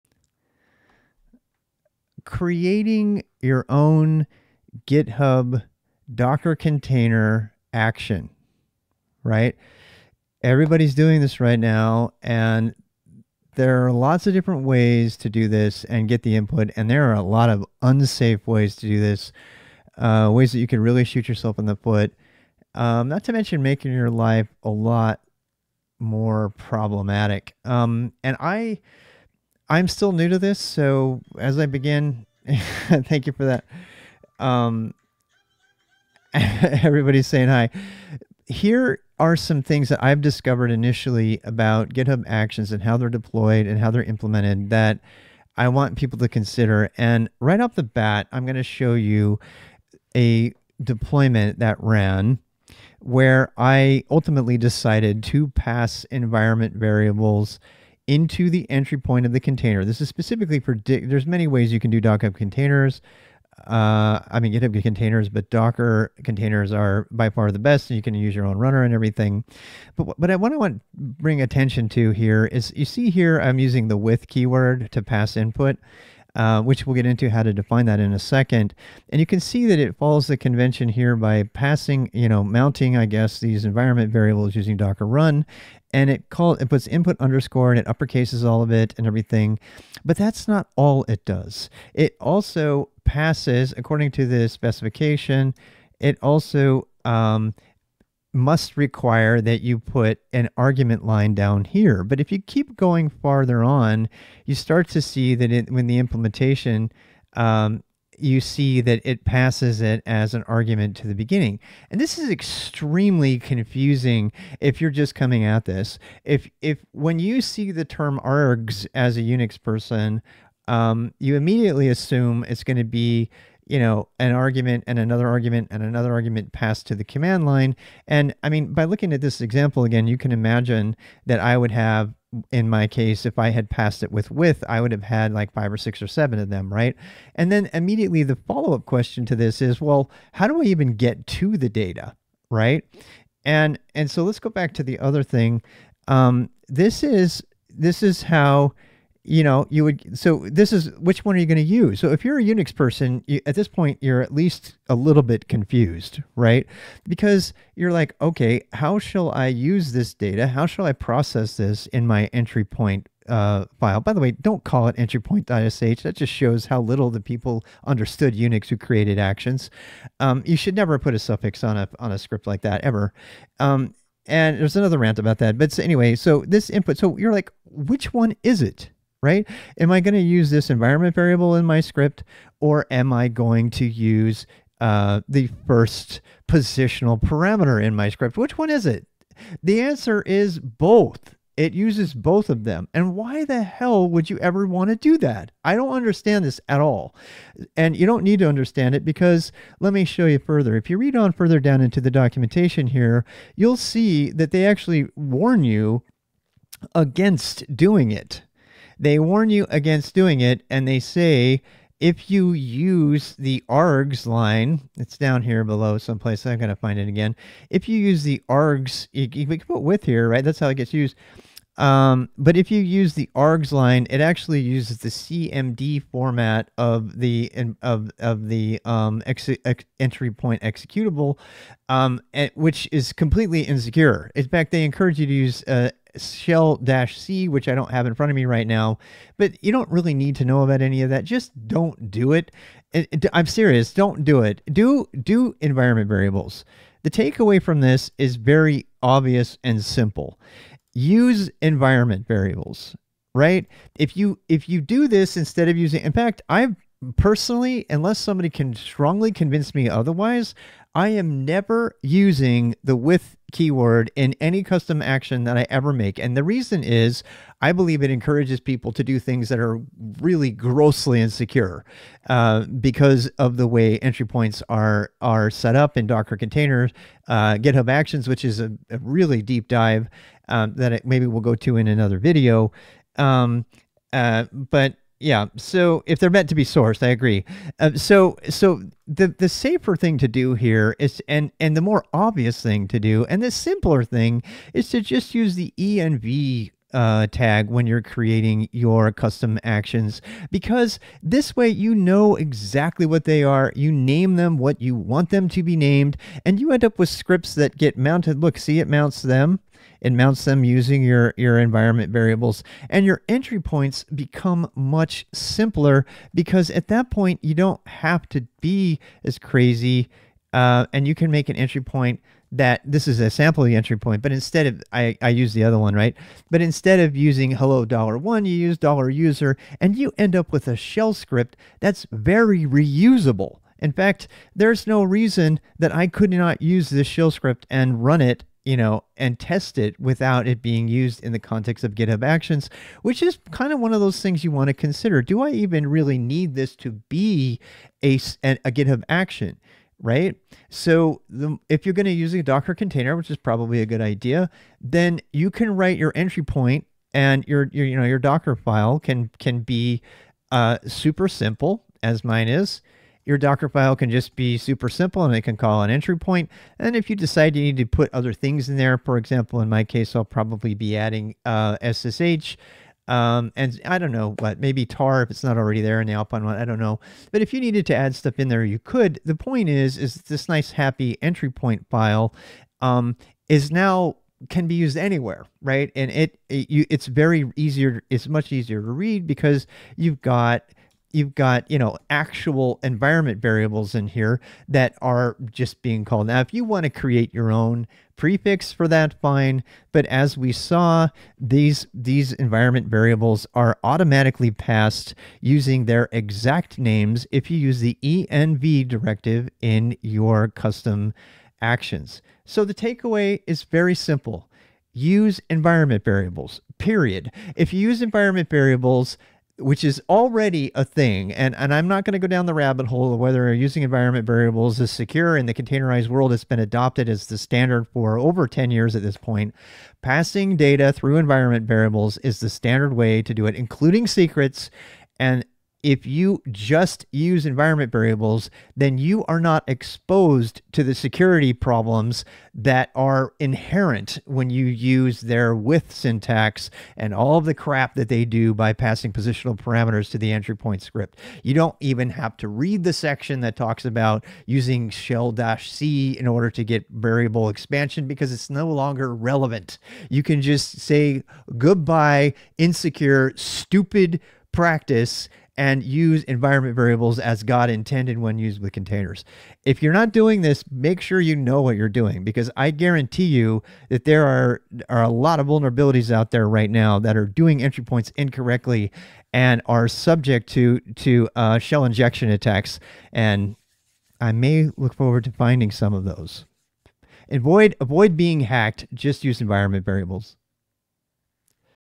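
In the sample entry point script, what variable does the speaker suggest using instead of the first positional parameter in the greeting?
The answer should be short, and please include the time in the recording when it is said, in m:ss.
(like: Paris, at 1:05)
$USER, at 5:28.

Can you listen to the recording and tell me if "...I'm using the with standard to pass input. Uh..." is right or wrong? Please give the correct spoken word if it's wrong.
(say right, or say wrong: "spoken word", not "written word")
wrong: "keyword", not "standard".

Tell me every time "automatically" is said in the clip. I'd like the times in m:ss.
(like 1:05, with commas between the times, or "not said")
6:43.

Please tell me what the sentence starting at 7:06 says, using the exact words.
It's been adopted as the standard for over 10 years at this point.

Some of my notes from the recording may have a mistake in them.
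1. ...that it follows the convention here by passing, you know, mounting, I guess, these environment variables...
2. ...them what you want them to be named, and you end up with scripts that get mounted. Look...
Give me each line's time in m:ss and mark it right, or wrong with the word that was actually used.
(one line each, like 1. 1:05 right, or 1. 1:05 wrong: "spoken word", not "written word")
1. 1:19 right
2. 5:04 right.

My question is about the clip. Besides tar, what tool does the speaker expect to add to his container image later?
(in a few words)
SSH.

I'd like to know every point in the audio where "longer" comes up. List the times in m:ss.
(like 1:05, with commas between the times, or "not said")
7:38.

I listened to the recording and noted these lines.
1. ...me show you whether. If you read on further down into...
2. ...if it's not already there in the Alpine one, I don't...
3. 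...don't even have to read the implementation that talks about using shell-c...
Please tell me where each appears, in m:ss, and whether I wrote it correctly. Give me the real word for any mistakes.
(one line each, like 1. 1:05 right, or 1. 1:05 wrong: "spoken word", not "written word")
1. 3:19 wrong: "further", not "whether"
2. 6:15 right
3. 7:31 wrong: "section", not "implementation".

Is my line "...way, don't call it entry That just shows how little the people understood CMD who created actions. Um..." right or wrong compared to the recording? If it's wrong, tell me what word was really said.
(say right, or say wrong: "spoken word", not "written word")
wrong: "Unix", not "CMD".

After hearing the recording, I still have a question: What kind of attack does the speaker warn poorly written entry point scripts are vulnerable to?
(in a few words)
Shell injection.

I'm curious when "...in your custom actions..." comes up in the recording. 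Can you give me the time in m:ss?
6:49.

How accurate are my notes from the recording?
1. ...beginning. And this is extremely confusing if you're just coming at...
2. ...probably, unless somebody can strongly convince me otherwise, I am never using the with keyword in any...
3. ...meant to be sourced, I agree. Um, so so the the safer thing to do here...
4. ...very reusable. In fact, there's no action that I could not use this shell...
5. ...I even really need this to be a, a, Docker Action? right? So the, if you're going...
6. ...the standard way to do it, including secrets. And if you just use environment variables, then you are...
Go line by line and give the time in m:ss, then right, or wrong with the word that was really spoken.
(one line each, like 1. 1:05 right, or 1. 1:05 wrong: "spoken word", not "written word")
1. 1:51 right
2. 4:17 wrong: "personally", not "probably"
3. 4:46 right
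4. 5:32 wrong: "reason", not "action"
5. 5:45 wrong: "GitHub", not "Docker"
6. 7:12 right.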